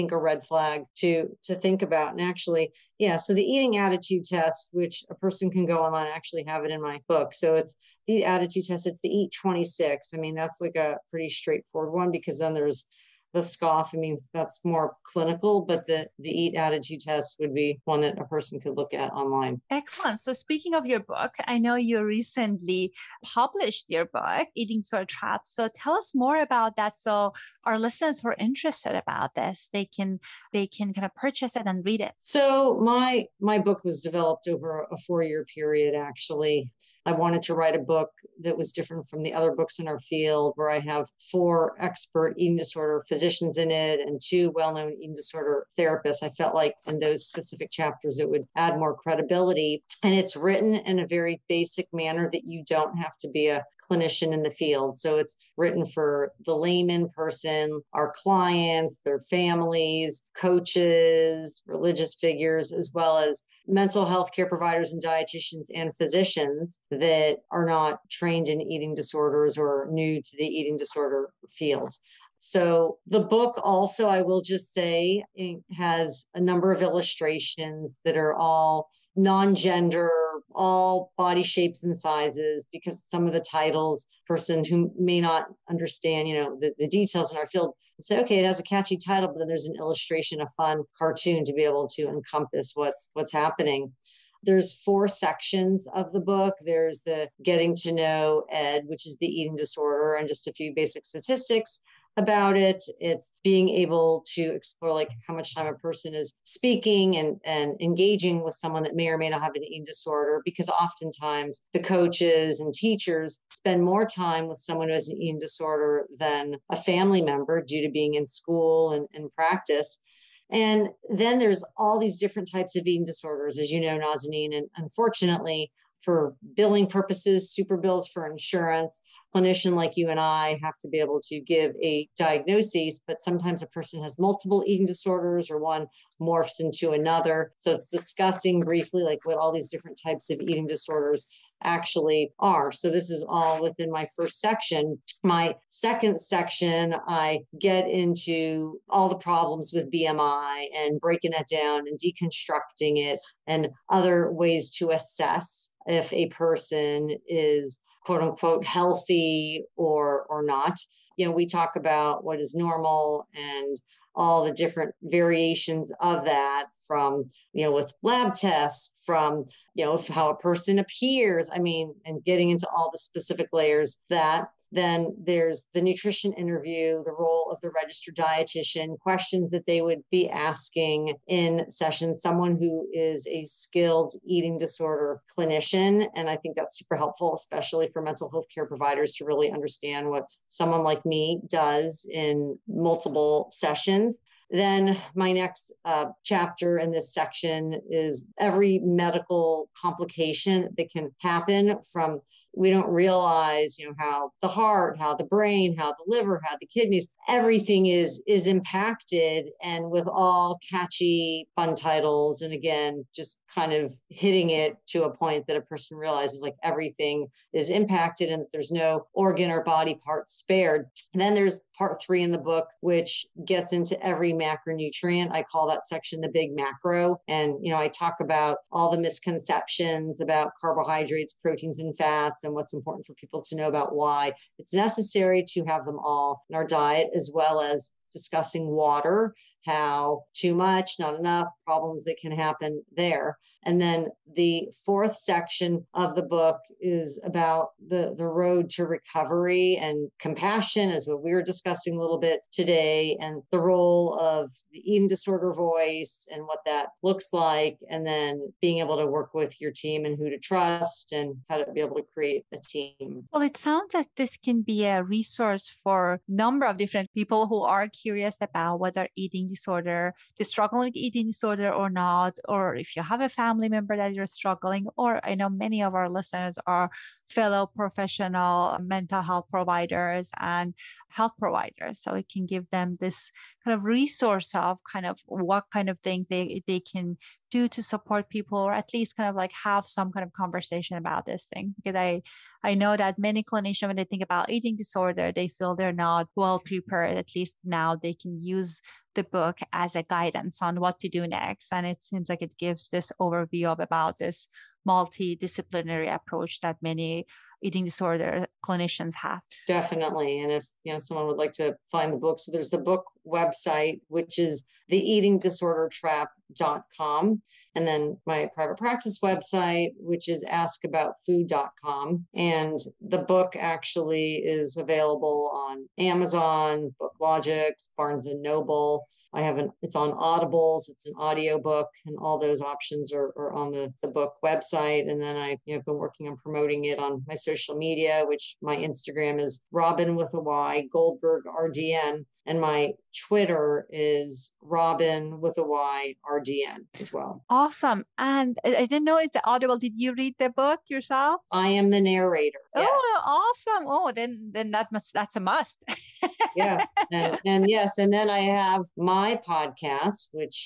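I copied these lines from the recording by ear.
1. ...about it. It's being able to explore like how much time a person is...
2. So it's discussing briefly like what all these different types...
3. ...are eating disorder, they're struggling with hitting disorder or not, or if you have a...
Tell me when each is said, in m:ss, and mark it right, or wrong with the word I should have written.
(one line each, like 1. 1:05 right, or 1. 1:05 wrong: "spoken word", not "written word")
1. 1:42 right
2. 2:17 right
3. 4:28 wrong: "eating", not "hitting".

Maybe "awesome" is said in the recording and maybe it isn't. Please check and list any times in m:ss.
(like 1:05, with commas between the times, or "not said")
5:47, 5:53.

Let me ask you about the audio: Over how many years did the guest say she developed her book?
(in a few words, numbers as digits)
4.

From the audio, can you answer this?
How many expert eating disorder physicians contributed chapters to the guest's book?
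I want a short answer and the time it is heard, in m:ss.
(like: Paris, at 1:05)
4, at 0:41.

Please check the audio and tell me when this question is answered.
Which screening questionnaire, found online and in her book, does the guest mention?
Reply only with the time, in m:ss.
0:09.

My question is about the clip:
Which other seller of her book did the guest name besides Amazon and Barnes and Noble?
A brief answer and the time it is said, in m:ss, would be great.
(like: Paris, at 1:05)
BookLogix, at 5:26.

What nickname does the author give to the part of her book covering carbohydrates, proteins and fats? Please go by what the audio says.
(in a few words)
The Big Macro.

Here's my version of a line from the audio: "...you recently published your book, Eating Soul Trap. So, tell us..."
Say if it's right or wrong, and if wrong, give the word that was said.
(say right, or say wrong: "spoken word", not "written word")
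right.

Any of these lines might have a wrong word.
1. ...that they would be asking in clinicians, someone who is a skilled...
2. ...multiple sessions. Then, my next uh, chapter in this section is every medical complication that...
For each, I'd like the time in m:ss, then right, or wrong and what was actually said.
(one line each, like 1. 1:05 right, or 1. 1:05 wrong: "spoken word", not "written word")
1. 2:59 wrong: "sessions", not "clinicians"
2. 3:12 right.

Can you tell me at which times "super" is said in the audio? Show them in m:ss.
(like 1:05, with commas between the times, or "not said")
2:07, 3:06.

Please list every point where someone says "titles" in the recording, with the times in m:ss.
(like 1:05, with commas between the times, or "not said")
1:23, 1:28, 3:31.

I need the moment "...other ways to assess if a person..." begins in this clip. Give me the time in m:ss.
2:33.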